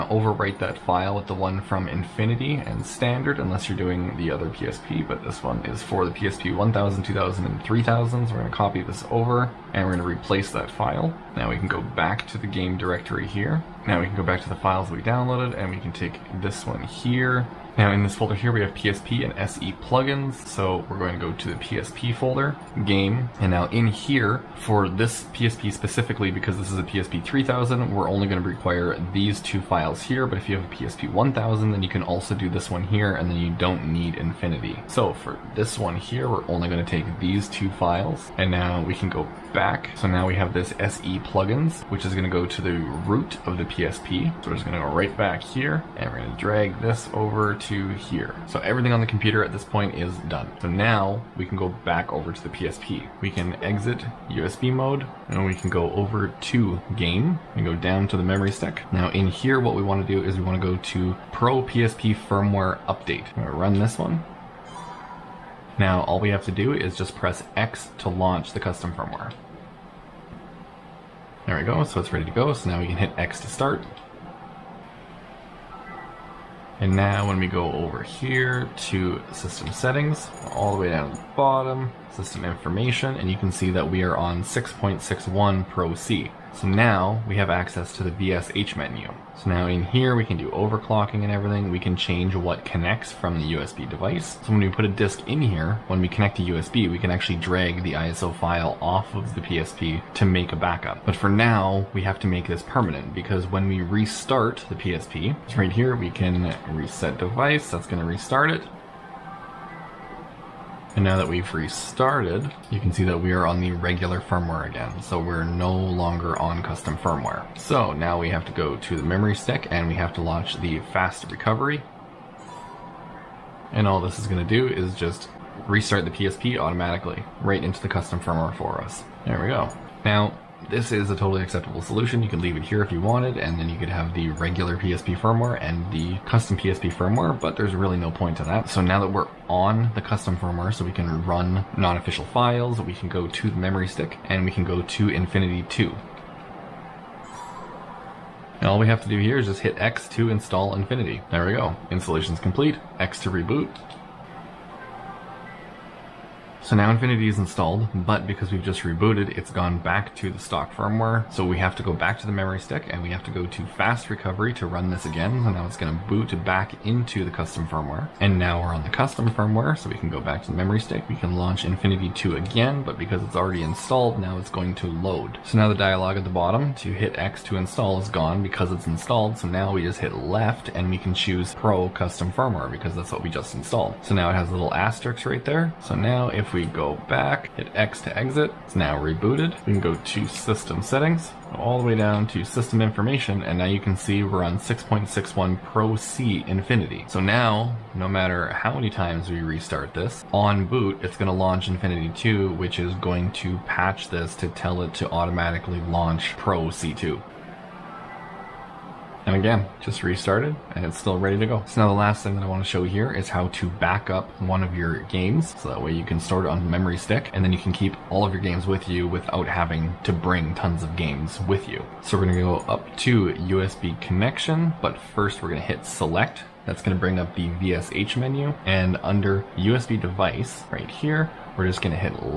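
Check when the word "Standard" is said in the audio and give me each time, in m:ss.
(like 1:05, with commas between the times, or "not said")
0:02.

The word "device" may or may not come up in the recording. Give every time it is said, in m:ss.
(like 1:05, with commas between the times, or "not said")
1:33, 1:47, 3:50.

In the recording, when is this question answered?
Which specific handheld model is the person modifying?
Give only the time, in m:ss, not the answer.
0:26.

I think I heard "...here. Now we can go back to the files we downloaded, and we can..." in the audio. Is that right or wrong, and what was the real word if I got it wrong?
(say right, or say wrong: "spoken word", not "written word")
right.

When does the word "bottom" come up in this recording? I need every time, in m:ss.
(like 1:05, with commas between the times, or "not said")
1:21, 2:56.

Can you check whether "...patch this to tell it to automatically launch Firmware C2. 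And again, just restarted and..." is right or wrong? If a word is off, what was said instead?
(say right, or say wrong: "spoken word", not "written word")
wrong: "Pro", not "Firmware".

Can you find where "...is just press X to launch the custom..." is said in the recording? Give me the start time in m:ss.
1:06.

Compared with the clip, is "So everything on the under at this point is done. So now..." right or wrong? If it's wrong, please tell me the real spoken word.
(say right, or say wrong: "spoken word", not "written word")
wrong: "computer", not "under".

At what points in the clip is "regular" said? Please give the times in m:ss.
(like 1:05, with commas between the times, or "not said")
1:53, 2:14.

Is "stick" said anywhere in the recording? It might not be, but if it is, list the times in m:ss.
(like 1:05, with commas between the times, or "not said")
0:58, 1:59, 2:23, 2:42, 2:50, 3:36.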